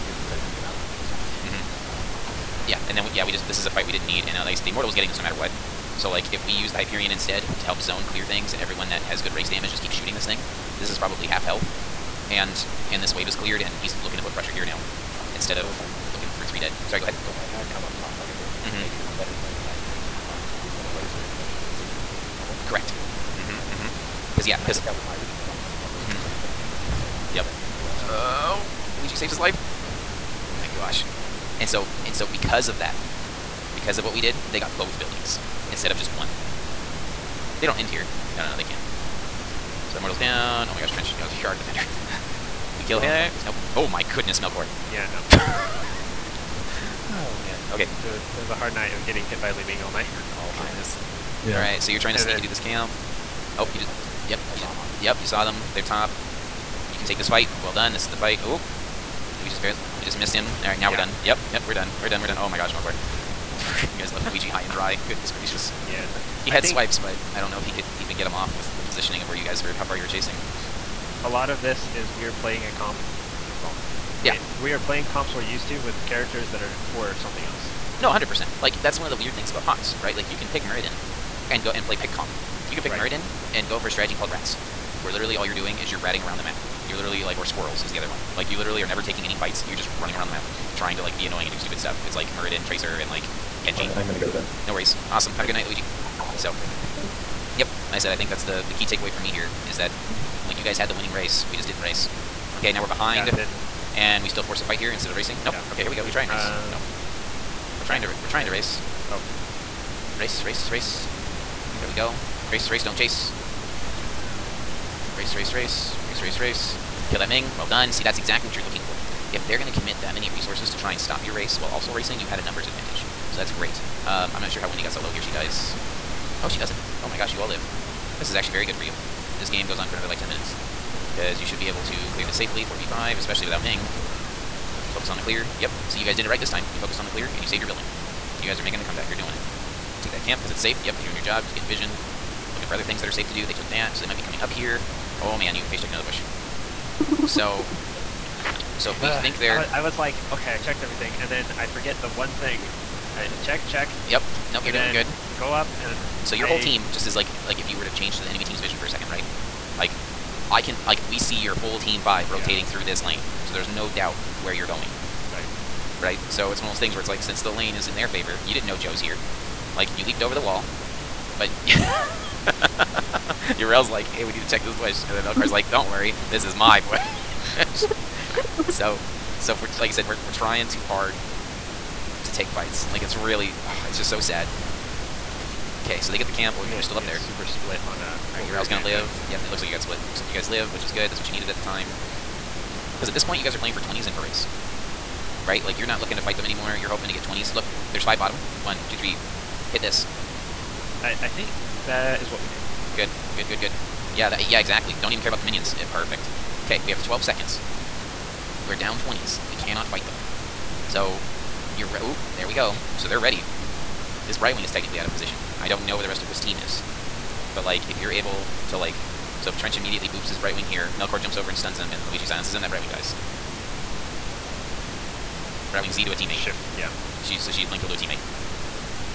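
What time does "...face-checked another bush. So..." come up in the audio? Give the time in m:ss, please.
2:25.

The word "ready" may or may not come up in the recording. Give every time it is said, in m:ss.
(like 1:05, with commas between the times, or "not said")
3:33.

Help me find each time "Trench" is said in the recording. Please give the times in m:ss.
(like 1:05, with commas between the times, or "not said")
0:40, 3:39.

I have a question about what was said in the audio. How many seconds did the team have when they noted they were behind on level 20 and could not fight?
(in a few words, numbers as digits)
12.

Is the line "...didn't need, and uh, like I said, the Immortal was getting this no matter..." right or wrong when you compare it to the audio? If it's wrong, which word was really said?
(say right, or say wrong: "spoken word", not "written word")
right.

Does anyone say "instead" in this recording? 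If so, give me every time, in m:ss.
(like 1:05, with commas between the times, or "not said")
0:07, 0:15, 0:35, 1:44.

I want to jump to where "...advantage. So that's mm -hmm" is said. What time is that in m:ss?
2:02.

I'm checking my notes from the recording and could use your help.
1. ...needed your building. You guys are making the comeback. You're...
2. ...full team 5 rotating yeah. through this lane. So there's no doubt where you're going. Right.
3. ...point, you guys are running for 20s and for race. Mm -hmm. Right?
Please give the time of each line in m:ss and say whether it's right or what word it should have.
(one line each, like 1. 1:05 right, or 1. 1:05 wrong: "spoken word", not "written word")
1. 2:17 wrong: "saved", not "needed"
2. 2:41 right
3. 3:13 wrong: "playing", not "running".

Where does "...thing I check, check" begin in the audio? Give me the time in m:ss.
2:32.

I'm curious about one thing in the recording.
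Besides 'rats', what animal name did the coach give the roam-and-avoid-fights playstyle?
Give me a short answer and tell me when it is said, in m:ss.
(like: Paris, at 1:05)
squirrels, at 1:27.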